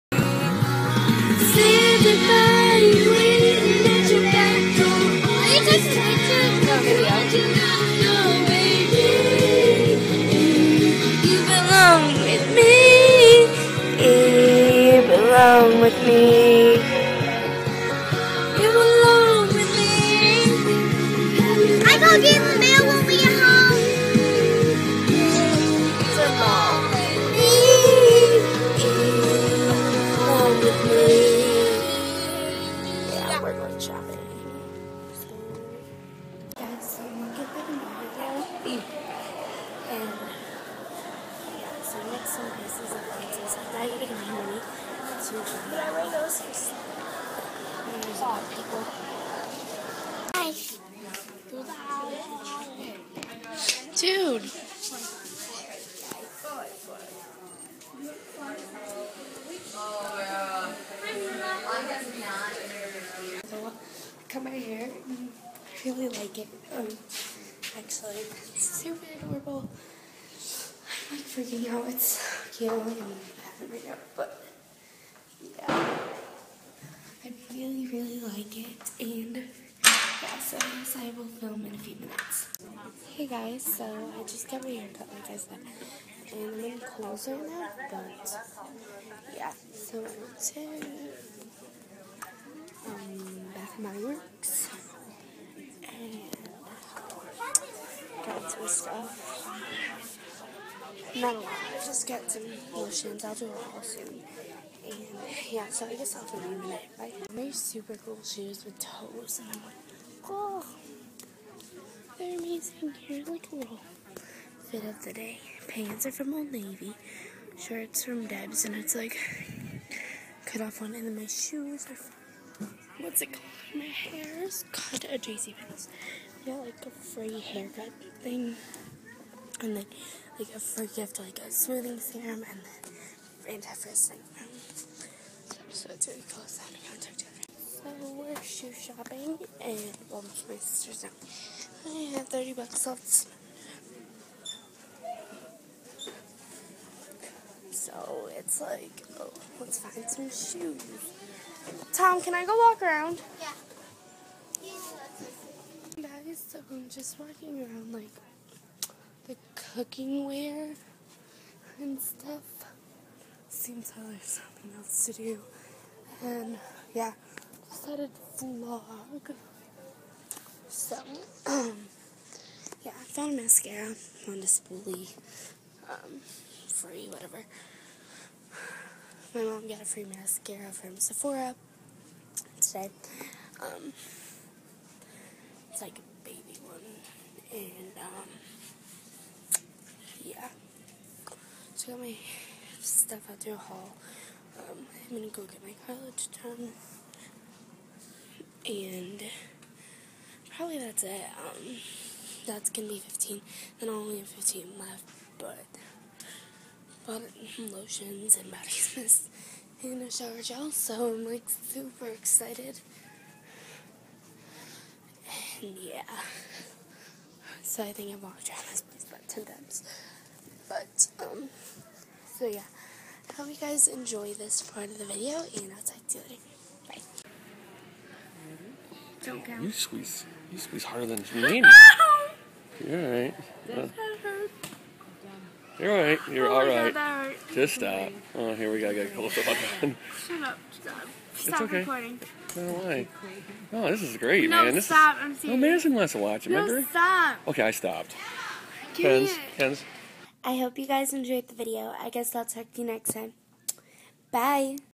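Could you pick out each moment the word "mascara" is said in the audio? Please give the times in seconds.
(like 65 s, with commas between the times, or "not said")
173 s, 180 s.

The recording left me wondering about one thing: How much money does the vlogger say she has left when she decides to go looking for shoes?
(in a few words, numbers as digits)
$30.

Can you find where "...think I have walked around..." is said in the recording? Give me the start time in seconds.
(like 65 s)
217 s.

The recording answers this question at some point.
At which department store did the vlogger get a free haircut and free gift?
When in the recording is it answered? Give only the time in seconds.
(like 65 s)
125 s.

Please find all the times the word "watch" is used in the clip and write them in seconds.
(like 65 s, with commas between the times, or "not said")
246 s.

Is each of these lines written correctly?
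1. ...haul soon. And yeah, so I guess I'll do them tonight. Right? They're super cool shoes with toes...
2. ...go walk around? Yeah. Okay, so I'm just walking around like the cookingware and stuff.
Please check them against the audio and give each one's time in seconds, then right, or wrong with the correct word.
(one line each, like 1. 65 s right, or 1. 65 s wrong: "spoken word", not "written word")
1. 103 s right
2. 152 s right.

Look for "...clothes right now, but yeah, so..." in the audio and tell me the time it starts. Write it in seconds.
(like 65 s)
86 s.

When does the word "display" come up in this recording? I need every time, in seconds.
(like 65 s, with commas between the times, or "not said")
174 s.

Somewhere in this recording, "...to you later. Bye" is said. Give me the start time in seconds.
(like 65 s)
226 s.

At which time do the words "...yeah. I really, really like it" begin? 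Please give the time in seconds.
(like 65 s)
75 s.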